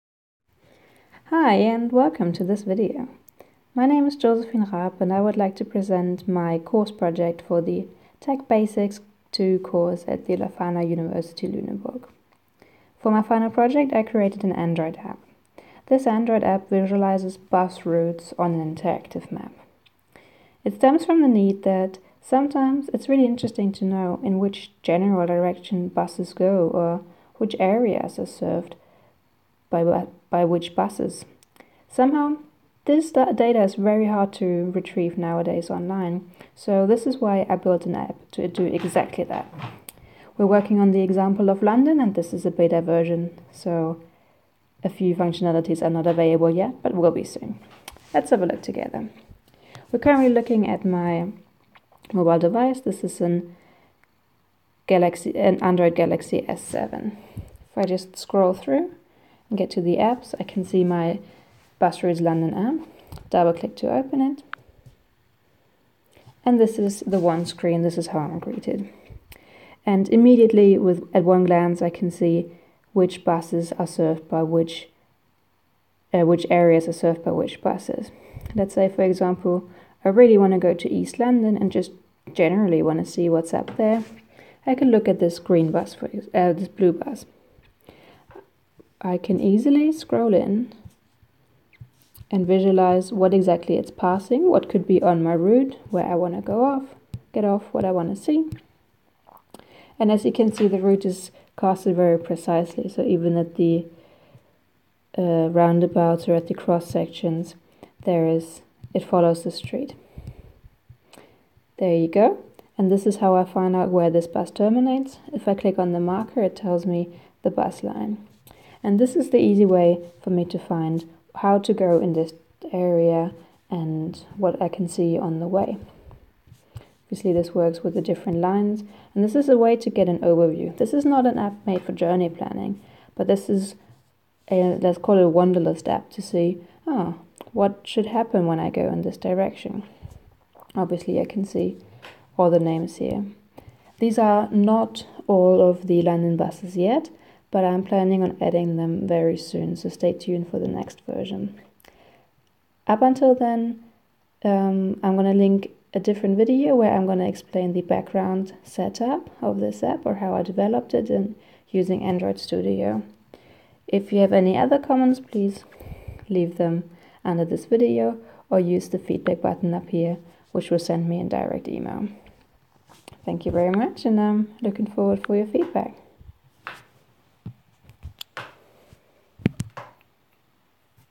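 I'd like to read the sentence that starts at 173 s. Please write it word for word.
Thank you very much, and I'm looking forward for your feedback.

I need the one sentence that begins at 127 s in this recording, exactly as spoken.
Obviously this works with the different lines and this is a way to get an overview.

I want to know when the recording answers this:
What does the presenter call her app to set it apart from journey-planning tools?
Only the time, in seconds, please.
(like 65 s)
135 s.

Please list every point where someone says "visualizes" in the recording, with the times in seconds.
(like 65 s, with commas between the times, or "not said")
16 s, 92 s.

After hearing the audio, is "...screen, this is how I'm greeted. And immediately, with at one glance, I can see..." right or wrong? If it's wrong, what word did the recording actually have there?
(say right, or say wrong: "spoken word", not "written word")
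right.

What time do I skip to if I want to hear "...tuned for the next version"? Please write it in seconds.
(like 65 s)
150 s.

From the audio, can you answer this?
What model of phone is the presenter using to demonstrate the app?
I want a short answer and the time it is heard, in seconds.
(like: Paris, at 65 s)
Galaxy S7, at 55 s.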